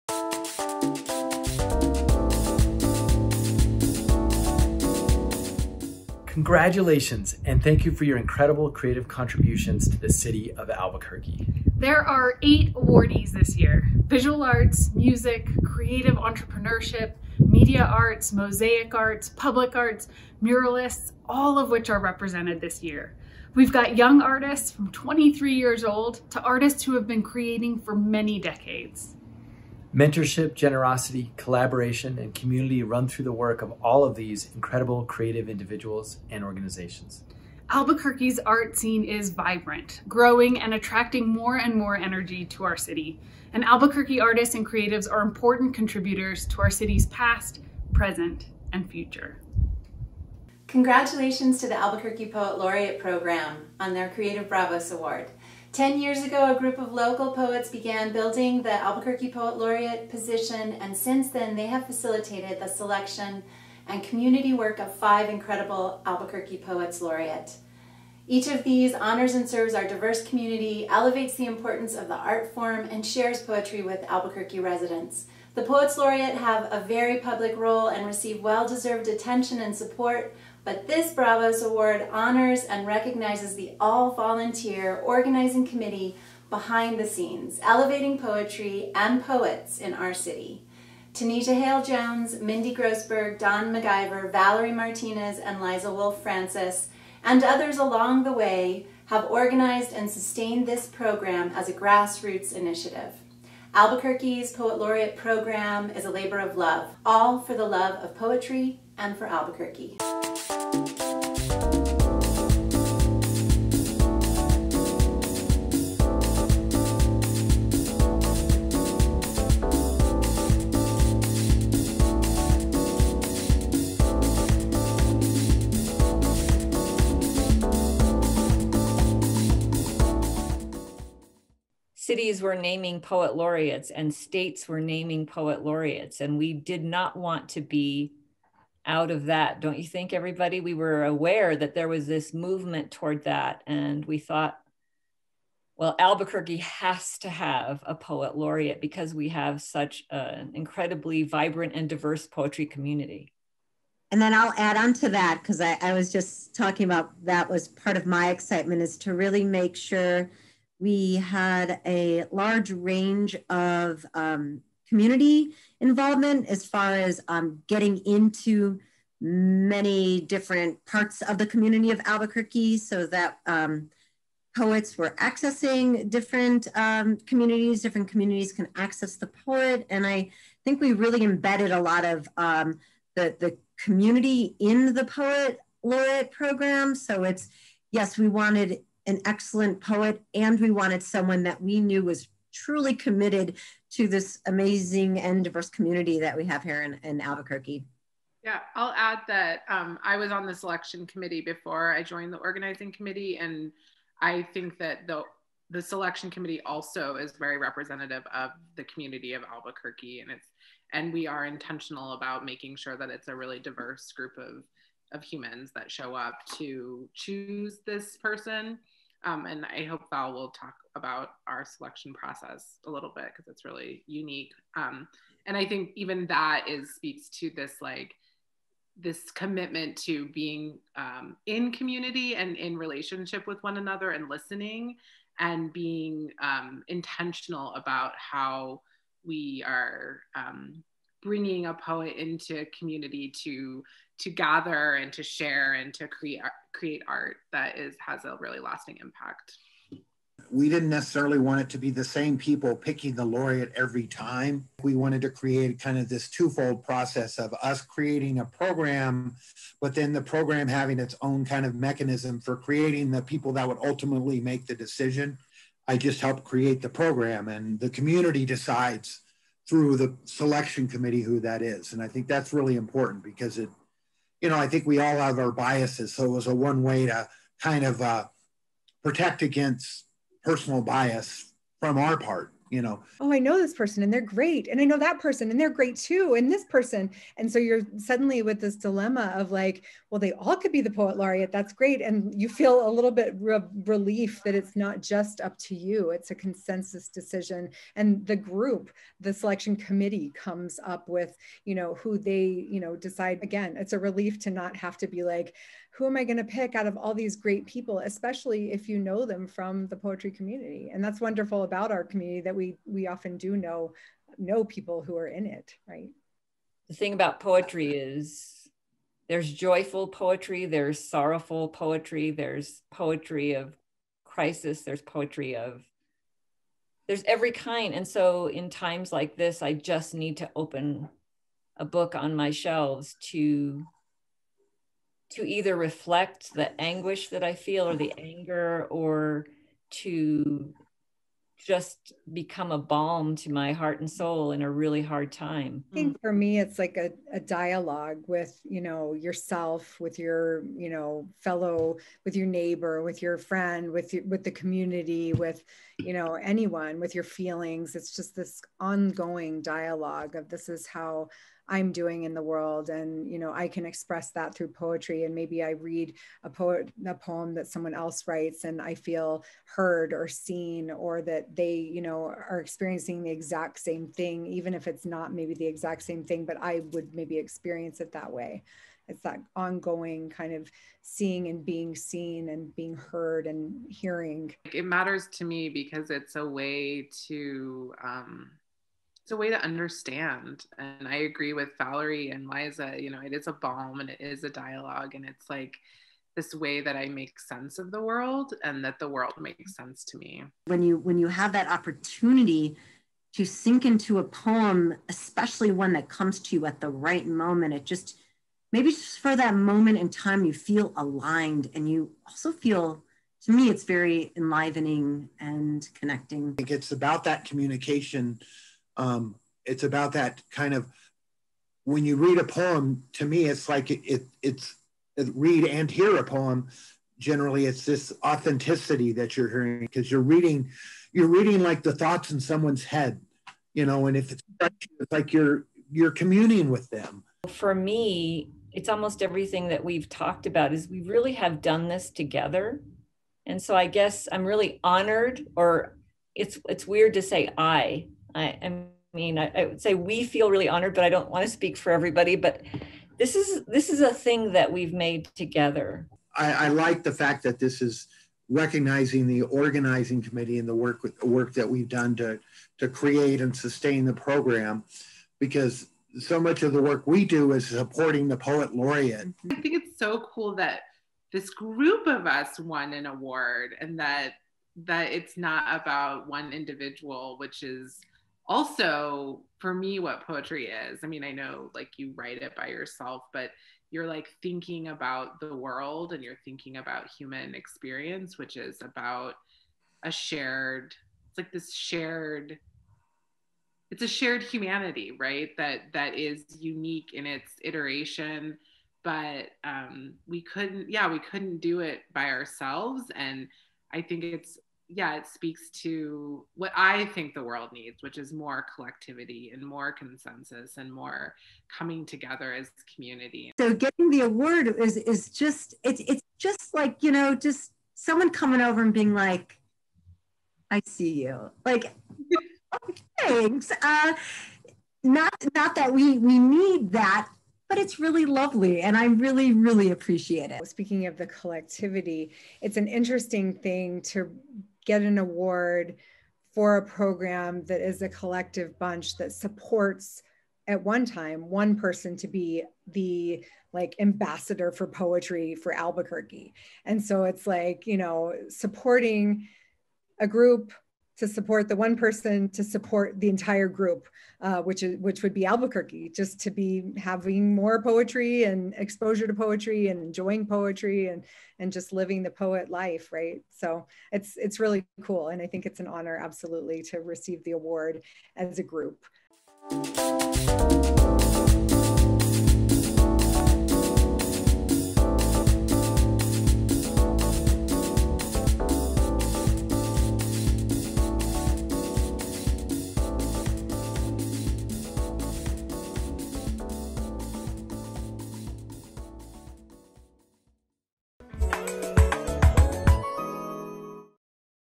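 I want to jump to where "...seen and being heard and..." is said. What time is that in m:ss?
6:21.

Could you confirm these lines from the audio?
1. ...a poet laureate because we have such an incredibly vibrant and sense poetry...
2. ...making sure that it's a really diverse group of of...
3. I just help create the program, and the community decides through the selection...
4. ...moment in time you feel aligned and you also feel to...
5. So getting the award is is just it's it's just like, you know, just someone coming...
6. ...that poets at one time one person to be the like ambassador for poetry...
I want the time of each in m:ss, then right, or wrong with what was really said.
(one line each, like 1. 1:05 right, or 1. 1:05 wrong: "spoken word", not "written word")
1. 2:27 wrong: "diverse", not "sense"
2. 3:32 right
3. 4:25 right
4. 6:49 right
5. 8:33 right
6. 8:59 wrong: "supports", not "poets".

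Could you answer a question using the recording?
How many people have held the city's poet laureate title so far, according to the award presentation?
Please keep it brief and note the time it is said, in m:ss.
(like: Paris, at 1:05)
5, at 1:04.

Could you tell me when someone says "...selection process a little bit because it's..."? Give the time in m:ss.
3:41.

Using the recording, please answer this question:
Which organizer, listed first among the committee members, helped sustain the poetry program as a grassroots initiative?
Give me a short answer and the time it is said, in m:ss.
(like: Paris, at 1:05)
Tanita Hale Jones, at 1:31.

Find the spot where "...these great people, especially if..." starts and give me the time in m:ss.
5:07.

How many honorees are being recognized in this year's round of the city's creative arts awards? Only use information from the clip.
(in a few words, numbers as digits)
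8.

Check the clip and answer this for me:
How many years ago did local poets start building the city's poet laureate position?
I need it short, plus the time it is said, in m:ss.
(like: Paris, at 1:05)
10, at 0:55.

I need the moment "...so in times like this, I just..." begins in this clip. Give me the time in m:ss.
5:28.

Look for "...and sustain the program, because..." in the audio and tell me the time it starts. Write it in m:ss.
7:43.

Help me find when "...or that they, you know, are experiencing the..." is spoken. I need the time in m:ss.
6:10.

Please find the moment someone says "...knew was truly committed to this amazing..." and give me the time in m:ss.
3:11.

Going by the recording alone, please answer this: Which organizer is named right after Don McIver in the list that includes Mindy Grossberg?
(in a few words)
Valerie Martinez.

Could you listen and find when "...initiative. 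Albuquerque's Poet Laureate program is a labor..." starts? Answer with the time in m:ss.
1:42.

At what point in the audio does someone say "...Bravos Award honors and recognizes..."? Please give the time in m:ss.
1:21.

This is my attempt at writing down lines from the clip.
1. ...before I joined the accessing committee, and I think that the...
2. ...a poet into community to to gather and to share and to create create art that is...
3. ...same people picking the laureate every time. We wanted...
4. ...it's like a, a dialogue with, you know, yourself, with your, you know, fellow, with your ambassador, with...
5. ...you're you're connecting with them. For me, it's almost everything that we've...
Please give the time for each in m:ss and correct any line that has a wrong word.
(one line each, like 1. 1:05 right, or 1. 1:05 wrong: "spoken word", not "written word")
1. 3:21 wrong: "organizing", not "accessing"
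2. 4:01 right
3. 4:12 right
4. 5:46 wrong: "neighbor", not "ambassador"
5. 7:15 wrong: "communing", not "connecting".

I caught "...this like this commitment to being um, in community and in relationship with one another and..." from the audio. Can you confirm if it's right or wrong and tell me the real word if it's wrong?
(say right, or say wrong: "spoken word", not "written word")
right.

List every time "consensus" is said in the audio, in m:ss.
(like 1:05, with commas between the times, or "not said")
4:56, 8:29.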